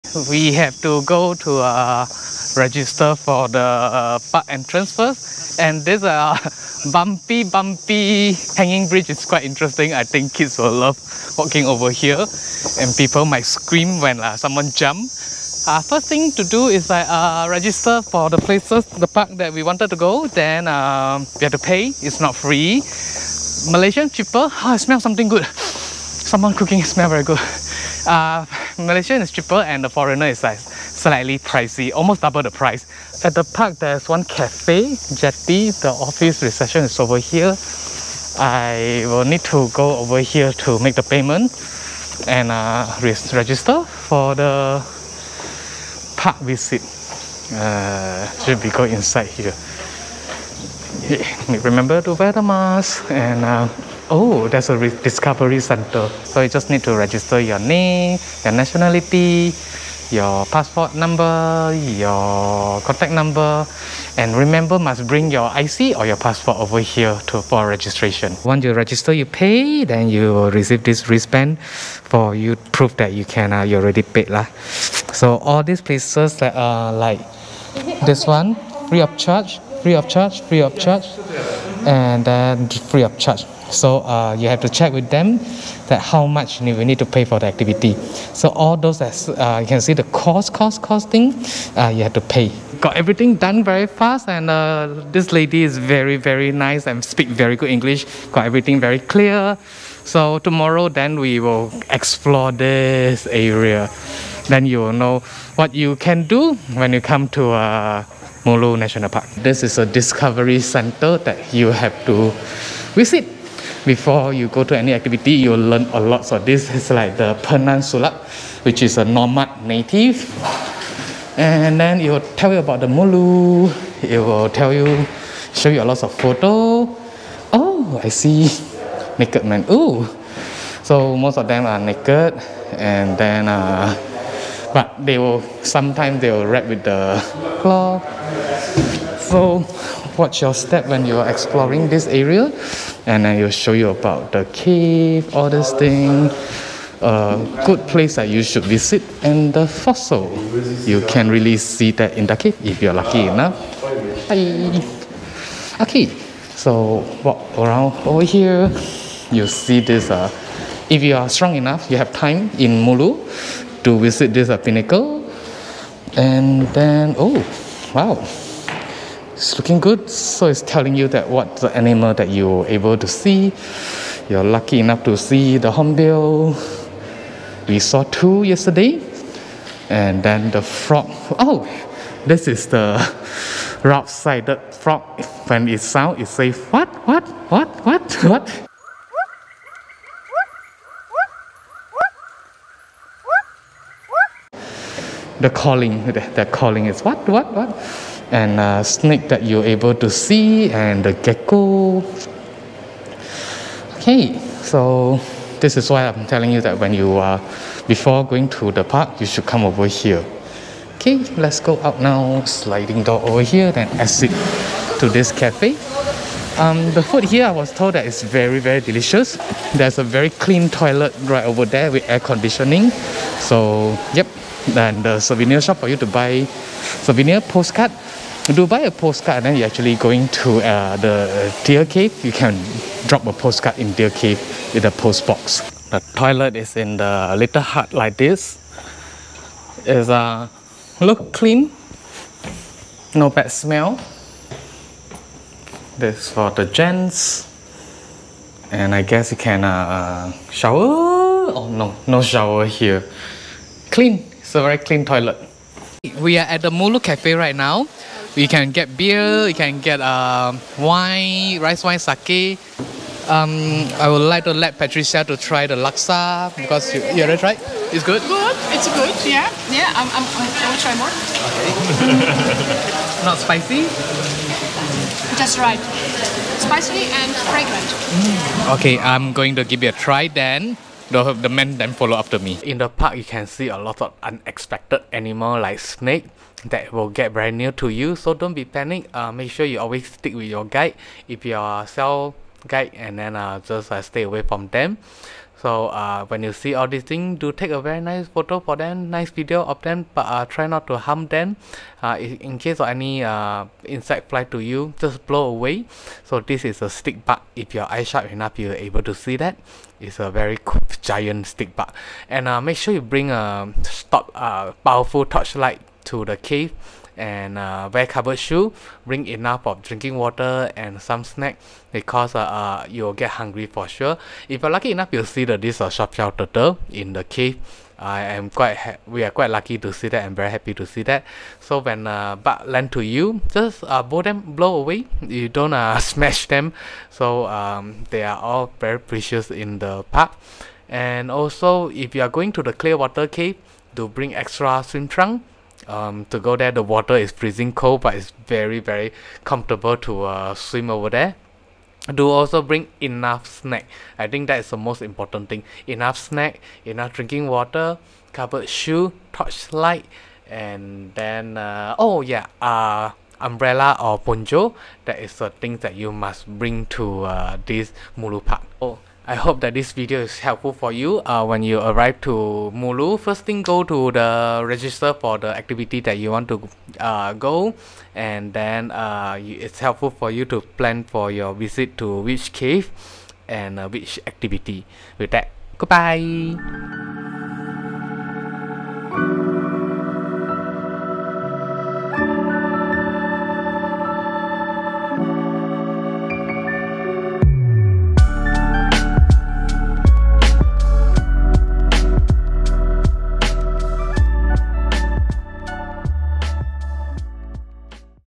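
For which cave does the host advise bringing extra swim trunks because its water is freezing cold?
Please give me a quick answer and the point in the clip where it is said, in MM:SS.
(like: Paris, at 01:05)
Clearwater Cave, at 05:42.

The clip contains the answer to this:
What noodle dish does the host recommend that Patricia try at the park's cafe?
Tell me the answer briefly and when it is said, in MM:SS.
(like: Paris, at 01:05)
laksa, at 04:25.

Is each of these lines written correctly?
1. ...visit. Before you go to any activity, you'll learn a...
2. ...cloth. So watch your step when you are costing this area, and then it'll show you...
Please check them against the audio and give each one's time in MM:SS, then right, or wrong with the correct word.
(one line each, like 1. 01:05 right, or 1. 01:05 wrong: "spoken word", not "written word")
1. 01:52 right
2. 02:17 wrong: "exploring", not "costing".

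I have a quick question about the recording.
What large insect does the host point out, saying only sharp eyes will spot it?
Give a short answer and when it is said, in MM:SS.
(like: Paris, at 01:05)
giant stick bug, at 05:11.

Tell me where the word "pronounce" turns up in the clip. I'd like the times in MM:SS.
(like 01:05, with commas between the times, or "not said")
not said.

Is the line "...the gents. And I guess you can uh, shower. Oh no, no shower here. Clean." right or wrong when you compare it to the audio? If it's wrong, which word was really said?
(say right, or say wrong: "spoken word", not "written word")
right.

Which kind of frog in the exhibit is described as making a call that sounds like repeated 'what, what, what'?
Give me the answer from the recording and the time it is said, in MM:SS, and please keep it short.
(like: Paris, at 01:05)
rough-sided frog, at 03:03.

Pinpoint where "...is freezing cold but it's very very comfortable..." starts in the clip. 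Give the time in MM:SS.
05:47.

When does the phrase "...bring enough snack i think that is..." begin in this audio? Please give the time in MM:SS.
05:52.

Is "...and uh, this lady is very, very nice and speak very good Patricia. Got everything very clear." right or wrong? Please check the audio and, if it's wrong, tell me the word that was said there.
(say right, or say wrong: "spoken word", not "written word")
wrong: "English", not "Patricia".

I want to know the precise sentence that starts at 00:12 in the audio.
And people might scream when uh, someone jump.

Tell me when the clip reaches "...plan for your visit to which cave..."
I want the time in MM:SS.
06:20.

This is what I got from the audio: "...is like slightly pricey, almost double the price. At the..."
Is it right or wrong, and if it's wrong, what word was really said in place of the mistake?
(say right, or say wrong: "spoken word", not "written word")
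right.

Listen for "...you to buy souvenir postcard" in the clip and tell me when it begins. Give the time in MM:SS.
03:45.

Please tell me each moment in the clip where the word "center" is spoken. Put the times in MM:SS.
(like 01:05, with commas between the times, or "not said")
00:55, 01:50.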